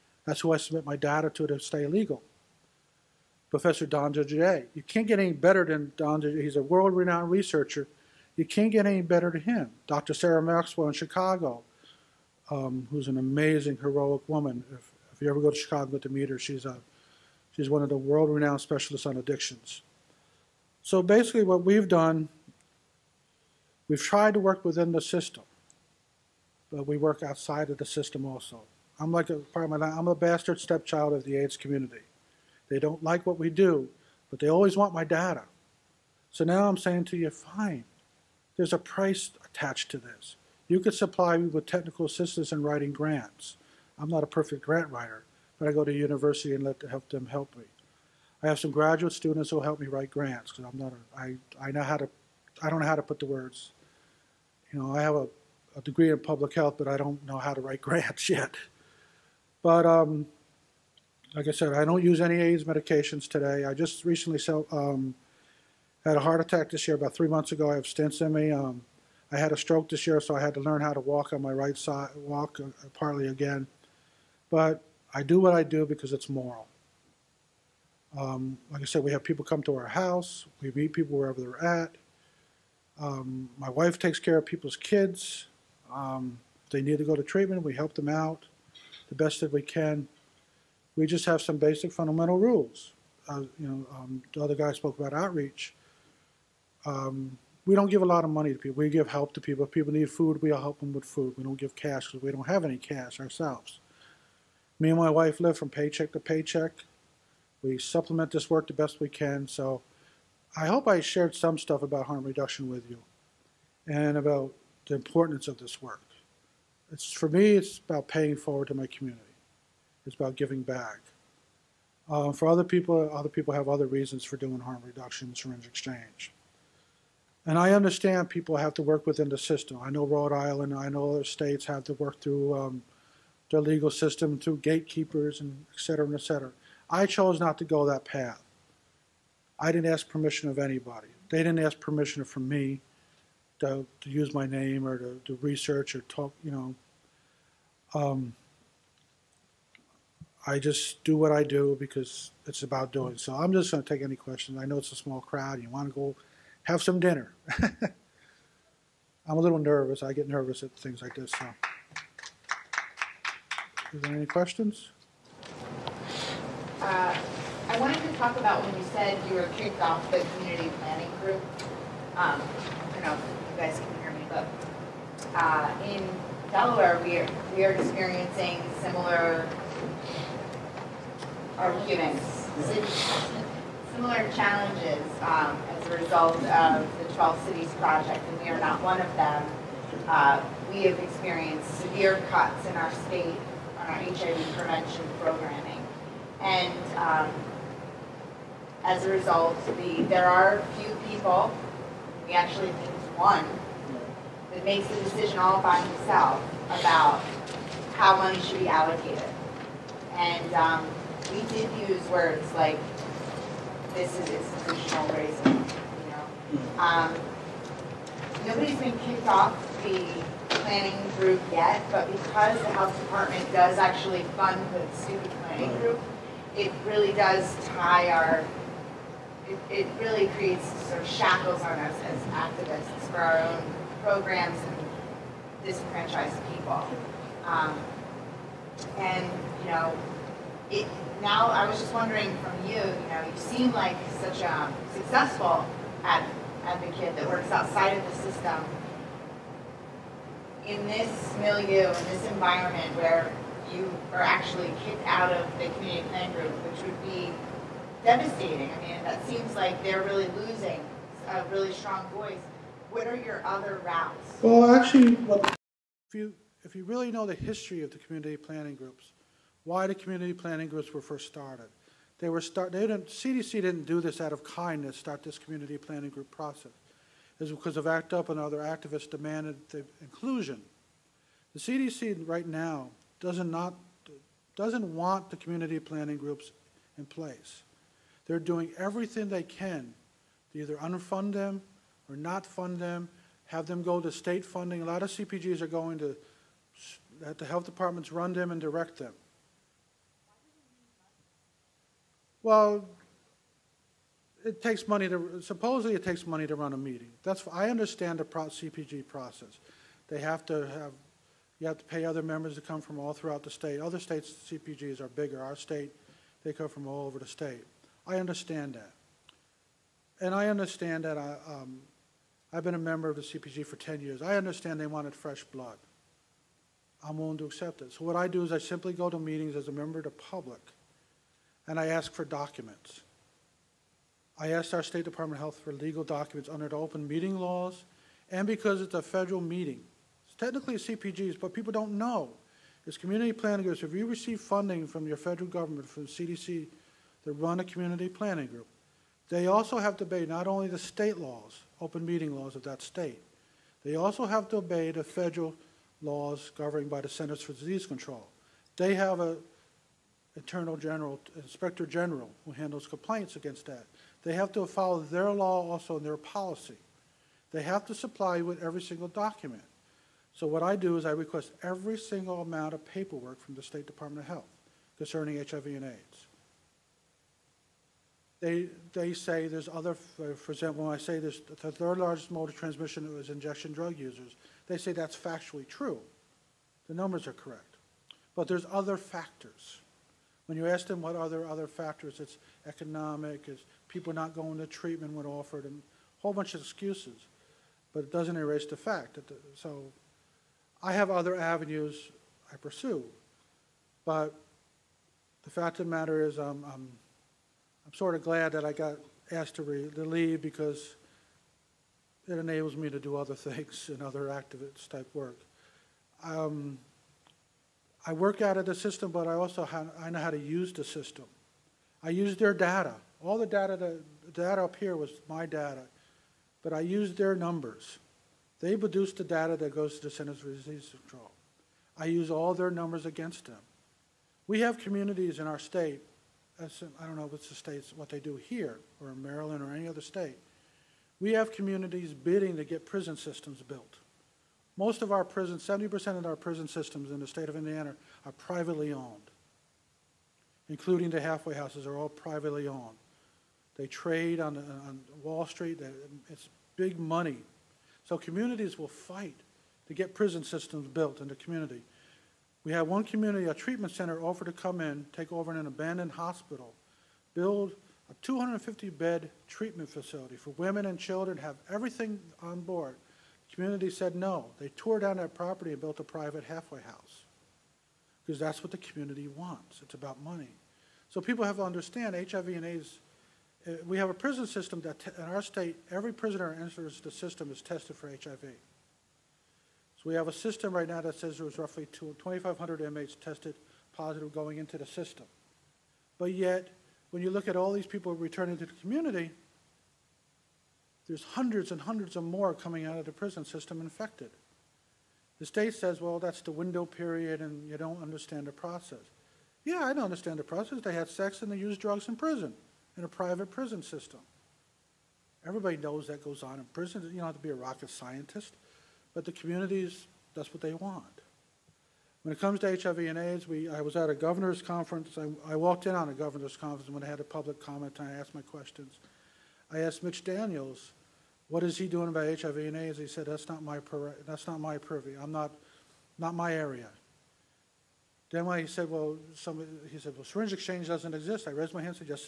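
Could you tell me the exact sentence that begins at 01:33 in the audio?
Uh, you know, um, the other guy spoke about outreach.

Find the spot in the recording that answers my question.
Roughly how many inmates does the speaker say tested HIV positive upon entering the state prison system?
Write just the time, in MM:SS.
08:11.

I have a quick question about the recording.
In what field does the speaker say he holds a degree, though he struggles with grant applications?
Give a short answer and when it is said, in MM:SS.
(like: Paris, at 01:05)
Public health, at 00:56.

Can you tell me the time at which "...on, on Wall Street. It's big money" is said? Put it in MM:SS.
07:34.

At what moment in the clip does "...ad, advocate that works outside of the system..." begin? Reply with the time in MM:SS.
04:06.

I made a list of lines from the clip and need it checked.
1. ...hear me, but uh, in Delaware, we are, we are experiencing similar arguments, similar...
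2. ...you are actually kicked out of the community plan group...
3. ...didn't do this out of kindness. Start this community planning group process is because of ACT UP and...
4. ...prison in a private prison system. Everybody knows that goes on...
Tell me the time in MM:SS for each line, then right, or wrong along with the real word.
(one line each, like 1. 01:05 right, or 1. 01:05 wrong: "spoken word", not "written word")
1. 02:54 right
2. 04:13 right
3. 04:33 right
4. 08:32 right.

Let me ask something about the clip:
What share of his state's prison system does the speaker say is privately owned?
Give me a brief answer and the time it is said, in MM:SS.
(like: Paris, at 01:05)
70%, at 07:25.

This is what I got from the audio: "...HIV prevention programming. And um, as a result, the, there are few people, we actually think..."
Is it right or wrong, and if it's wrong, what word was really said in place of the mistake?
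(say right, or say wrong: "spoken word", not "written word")
right.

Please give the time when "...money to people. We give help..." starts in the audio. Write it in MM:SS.
01:38.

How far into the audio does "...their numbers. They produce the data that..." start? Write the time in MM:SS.
07:07.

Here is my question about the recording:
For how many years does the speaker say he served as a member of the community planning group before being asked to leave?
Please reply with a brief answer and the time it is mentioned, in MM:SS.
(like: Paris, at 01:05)
10, at 05:23.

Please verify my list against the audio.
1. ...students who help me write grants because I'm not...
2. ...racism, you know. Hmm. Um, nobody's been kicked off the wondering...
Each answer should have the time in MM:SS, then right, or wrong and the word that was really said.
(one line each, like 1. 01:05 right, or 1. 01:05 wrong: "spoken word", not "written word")
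1. 00:49 right
2. 03:35 wrong: "planning", not "wondering".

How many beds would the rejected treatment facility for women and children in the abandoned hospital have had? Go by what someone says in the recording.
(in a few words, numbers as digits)
250.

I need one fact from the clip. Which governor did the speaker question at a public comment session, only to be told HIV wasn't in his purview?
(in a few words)
Mitch Daniels.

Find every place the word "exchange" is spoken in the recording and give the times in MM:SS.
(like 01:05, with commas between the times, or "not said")
02:05, 09:00.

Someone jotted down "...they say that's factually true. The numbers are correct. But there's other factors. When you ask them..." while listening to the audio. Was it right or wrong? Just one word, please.
right.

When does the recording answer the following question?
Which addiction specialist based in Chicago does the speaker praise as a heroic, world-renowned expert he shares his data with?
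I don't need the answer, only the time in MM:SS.
00:09.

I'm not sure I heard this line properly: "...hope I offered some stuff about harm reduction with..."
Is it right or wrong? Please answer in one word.
wrong.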